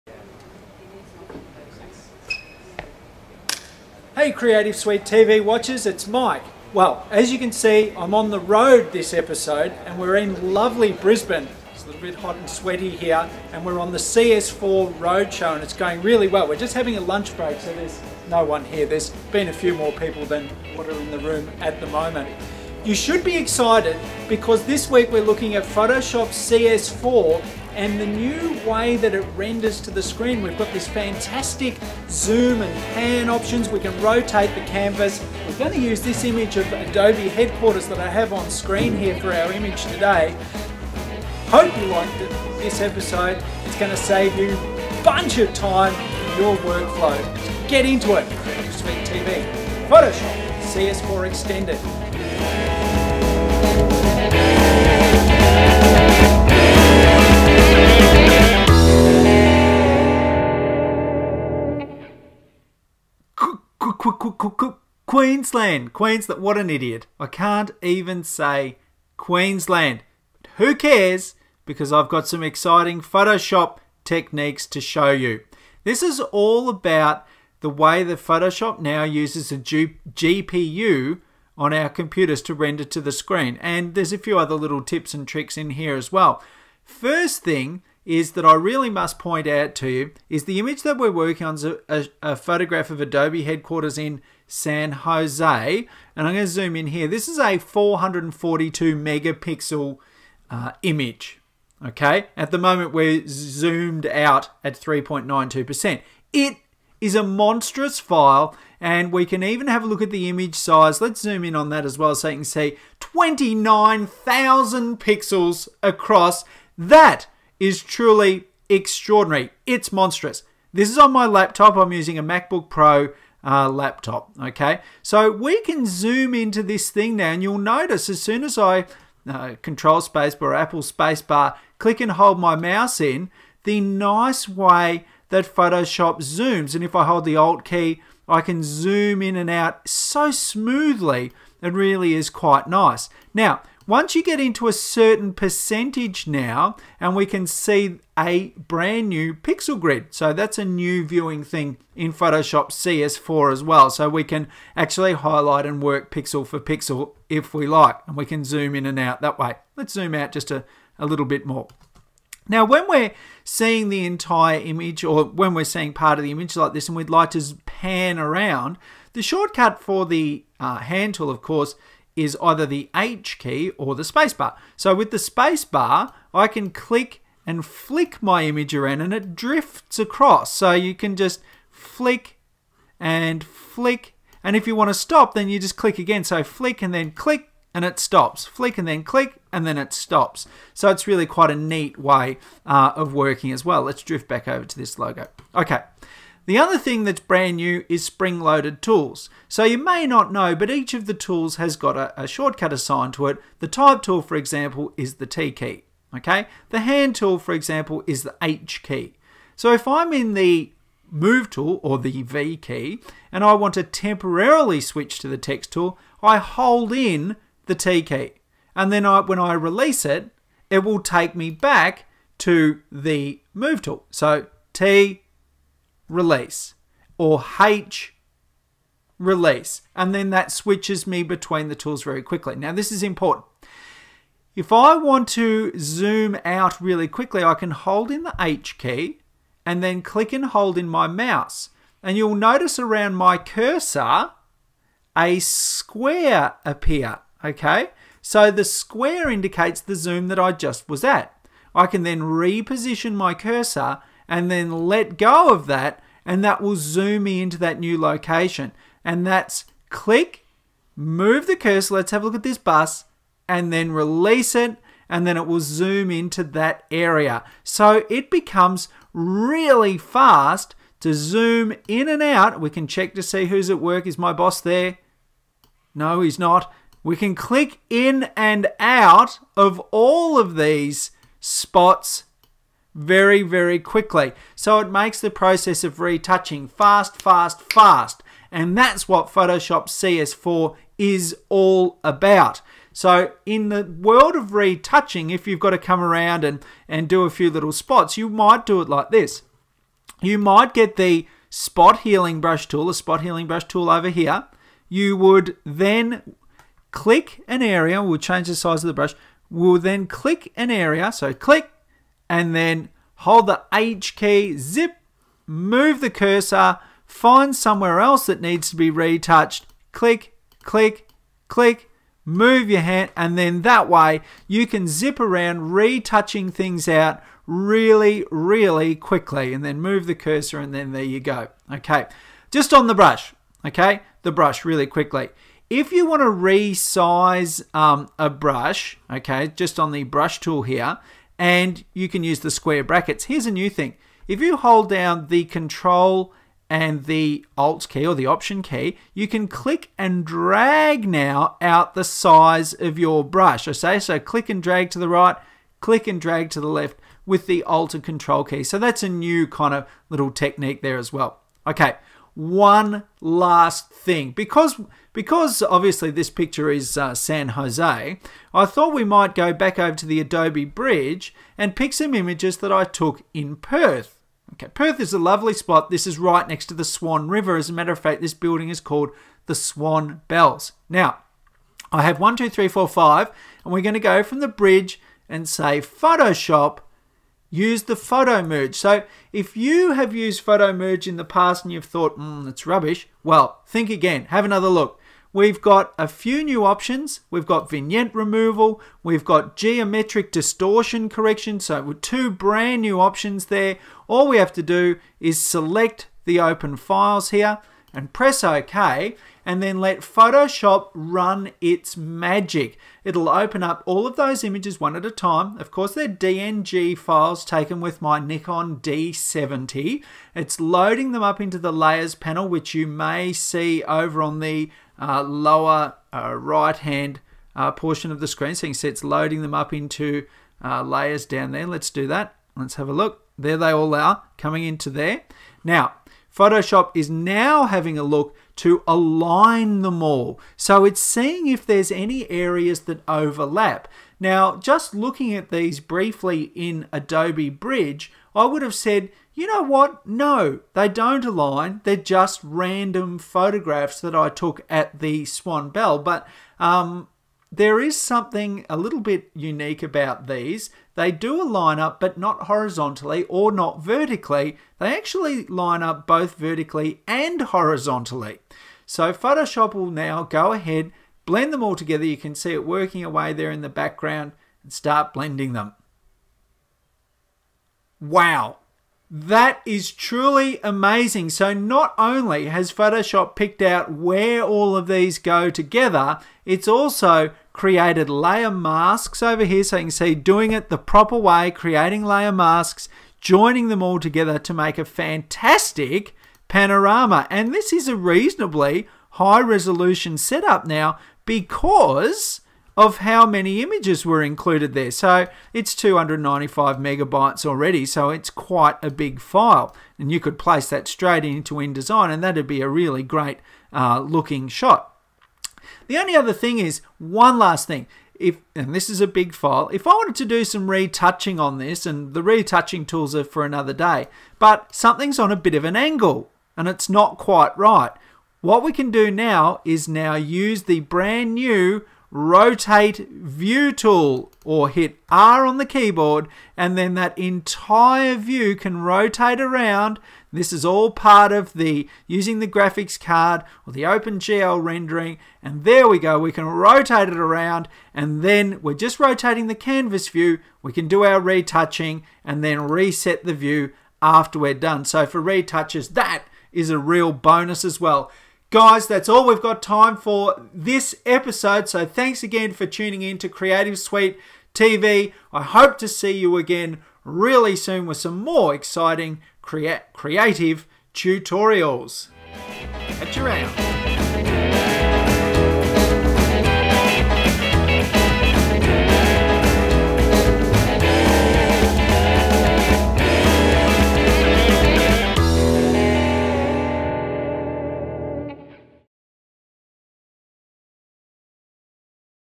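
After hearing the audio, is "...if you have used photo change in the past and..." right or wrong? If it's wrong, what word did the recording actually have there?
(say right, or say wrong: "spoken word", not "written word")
wrong: "merge", not "change".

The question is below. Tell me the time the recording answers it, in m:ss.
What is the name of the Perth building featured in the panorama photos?
6:19.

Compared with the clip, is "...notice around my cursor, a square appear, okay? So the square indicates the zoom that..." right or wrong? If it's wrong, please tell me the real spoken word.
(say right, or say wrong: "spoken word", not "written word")
right.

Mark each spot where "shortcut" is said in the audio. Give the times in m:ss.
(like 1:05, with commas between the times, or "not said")
2:49, 3:22.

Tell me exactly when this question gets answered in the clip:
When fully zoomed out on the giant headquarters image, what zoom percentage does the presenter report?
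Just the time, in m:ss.
1:44.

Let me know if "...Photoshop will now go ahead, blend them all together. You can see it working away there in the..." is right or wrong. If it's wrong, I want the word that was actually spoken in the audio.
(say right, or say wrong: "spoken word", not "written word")
right.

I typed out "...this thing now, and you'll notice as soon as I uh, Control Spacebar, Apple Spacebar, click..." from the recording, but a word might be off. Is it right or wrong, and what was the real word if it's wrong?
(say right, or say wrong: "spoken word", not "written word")
right.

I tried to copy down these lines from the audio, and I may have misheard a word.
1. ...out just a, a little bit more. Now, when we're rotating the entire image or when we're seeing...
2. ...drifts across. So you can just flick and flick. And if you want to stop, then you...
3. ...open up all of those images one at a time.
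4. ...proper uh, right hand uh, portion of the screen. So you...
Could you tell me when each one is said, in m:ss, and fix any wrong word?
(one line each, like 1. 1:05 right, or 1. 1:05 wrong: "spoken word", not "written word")
1. 2:40 wrong: "seeing", not "rotating"
2. 2:59 right
3. 6:53 right
4. 7:05 wrong: "lower", not "proper".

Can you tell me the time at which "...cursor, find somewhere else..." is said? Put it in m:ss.
5:16.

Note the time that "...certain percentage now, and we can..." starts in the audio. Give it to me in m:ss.
2:24.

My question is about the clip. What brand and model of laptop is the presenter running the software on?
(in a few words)
MacBook Pro.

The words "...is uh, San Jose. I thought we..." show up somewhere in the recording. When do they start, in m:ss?
6:06.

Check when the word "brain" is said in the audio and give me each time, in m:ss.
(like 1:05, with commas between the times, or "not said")
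not said.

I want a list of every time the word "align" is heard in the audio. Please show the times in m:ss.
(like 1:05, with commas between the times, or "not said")
7:18, 7:31.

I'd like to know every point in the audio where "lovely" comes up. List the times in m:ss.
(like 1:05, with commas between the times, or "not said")
0:10, 6:15.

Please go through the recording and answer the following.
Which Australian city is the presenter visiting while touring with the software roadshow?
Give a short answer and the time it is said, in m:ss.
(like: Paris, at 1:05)
Brisbane, at 0:10.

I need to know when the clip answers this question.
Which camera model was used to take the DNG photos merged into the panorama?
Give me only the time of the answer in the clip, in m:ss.
6:58.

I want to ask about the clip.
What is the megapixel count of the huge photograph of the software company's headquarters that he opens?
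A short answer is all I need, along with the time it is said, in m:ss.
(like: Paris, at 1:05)
442, at 1:37.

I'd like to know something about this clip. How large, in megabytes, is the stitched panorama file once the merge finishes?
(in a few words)
295 megabytes.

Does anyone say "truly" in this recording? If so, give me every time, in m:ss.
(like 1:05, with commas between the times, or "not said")
1:57, 7:59.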